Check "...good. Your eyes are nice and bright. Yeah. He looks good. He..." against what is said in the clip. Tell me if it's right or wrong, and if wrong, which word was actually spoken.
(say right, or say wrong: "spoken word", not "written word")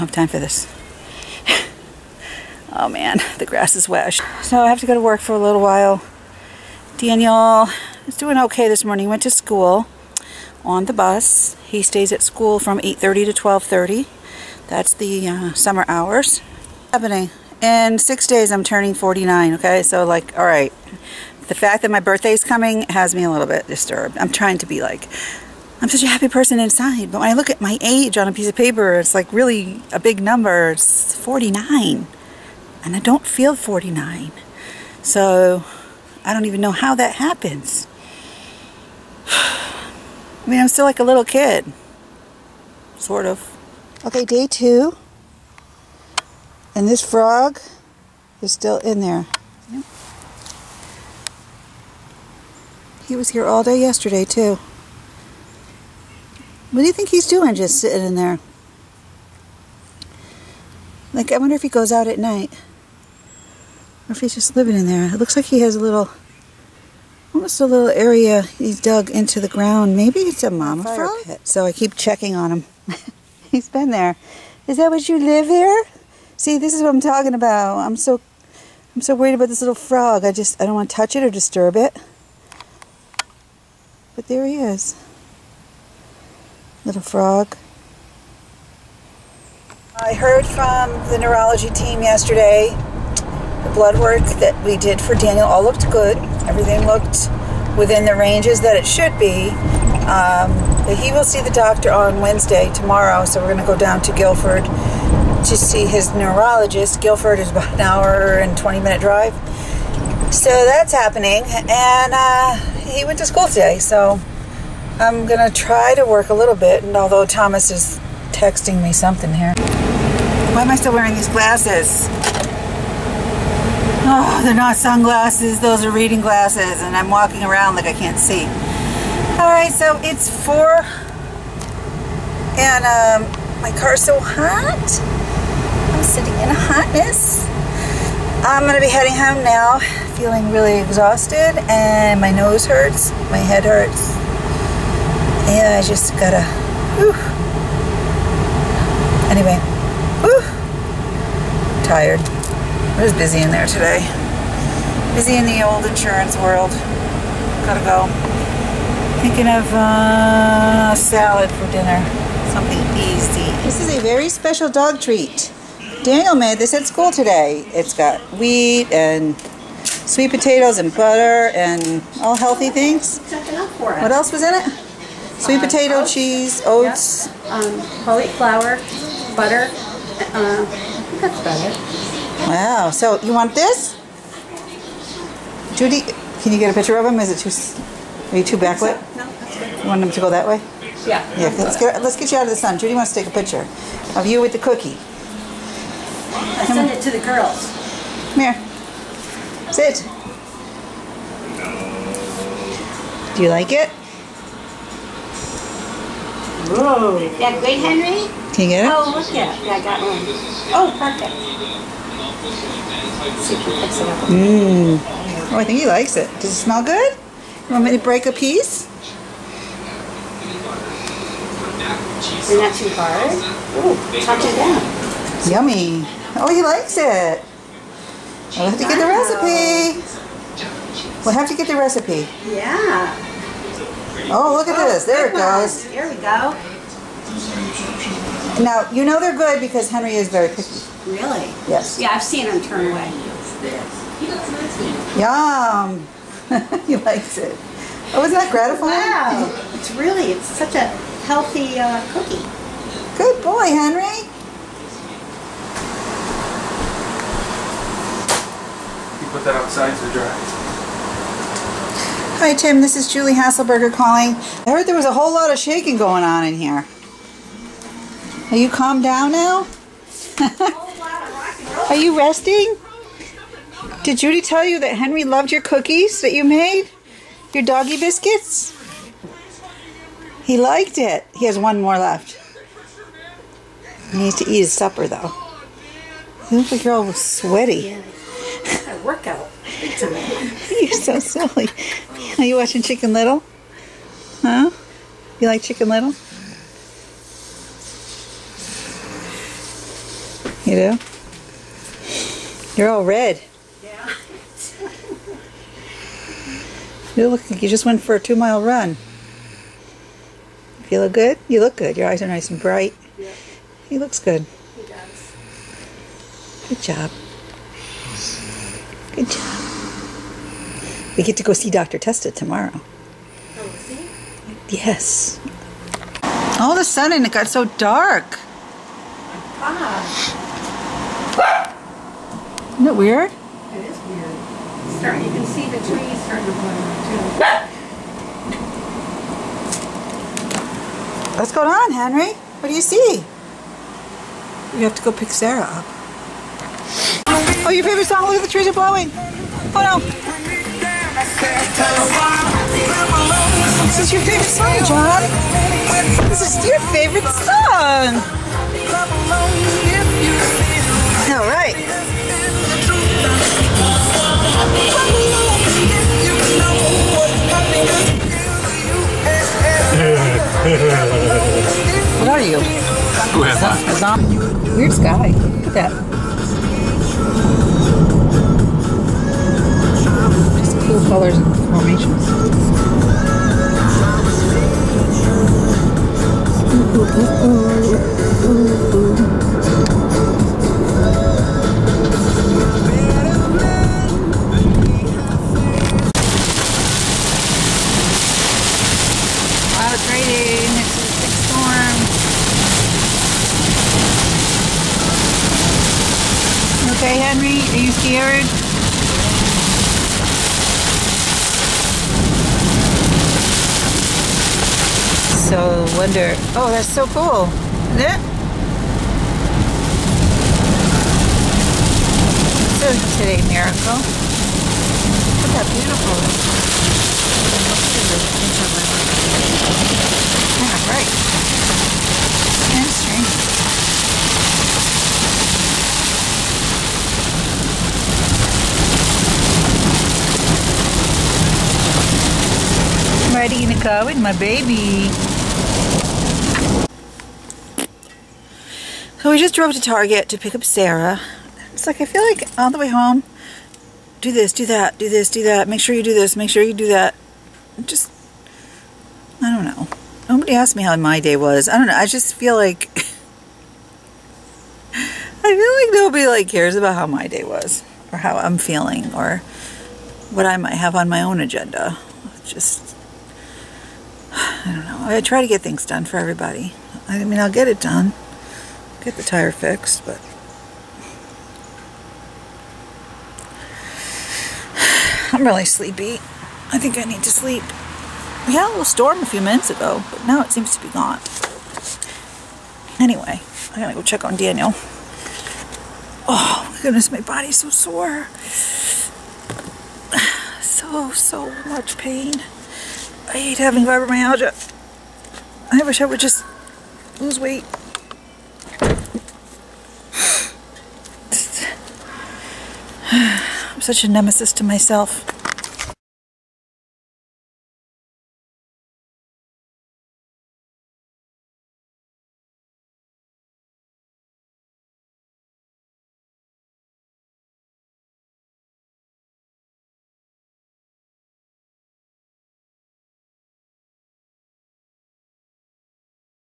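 right.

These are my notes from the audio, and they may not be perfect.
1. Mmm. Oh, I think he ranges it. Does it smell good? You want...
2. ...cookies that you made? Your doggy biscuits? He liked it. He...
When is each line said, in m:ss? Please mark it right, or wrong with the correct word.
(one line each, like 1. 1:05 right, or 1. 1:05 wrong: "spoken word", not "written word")
1. 3:34 wrong: "likes", not "ranges"
2. 4:35 right.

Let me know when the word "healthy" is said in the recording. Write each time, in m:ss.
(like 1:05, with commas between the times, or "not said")
2:52, 4:11.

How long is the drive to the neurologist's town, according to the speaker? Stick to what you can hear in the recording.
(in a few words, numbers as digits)
1 hour 20 minutes.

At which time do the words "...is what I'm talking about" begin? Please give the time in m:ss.
1:16.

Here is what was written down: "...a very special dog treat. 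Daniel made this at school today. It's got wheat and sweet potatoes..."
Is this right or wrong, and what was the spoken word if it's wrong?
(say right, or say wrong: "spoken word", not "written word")
right.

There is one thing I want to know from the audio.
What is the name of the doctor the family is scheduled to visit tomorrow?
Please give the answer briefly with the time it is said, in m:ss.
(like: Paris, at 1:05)
Dr. Testa, at 5:21.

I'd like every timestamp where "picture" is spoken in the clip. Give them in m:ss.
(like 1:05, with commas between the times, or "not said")
3:06, 3:13.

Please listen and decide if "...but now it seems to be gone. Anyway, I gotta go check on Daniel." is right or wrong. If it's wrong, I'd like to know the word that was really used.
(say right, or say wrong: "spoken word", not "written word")
right.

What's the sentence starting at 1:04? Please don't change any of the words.
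Or if he's just living in there.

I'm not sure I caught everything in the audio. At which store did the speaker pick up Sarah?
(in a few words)
Target.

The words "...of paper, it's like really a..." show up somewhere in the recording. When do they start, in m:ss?
0:28.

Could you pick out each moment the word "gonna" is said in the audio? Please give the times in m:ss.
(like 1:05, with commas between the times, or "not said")
1:55, 2:18.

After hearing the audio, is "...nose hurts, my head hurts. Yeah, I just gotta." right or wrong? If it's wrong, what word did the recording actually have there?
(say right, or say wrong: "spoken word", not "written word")
right.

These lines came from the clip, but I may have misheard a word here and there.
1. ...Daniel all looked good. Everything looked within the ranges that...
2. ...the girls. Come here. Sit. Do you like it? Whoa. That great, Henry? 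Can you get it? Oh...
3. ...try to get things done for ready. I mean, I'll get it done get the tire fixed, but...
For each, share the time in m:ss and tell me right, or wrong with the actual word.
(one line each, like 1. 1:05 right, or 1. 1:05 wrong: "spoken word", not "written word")
1. 1:35 right
2. 3:17 right
3. 7:55 wrong: "everybody", not "ready".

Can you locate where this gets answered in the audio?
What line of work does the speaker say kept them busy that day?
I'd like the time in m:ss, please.
2:35.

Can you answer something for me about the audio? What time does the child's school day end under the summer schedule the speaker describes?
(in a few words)
12:30.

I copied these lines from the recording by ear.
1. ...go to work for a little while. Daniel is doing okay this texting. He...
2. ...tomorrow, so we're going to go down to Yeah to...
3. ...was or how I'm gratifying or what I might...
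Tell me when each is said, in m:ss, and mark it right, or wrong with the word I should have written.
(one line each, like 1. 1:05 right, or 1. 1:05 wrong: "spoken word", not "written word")
1. 0:04 wrong: "morning", not "texting"
2. 1:42 wrong: "Guilford", not "Yeah"
3. 7:47 wrong: "feeling", not "gratifying".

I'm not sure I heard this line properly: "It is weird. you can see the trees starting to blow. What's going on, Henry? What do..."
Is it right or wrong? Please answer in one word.
right.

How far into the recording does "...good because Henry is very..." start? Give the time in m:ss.
3:59.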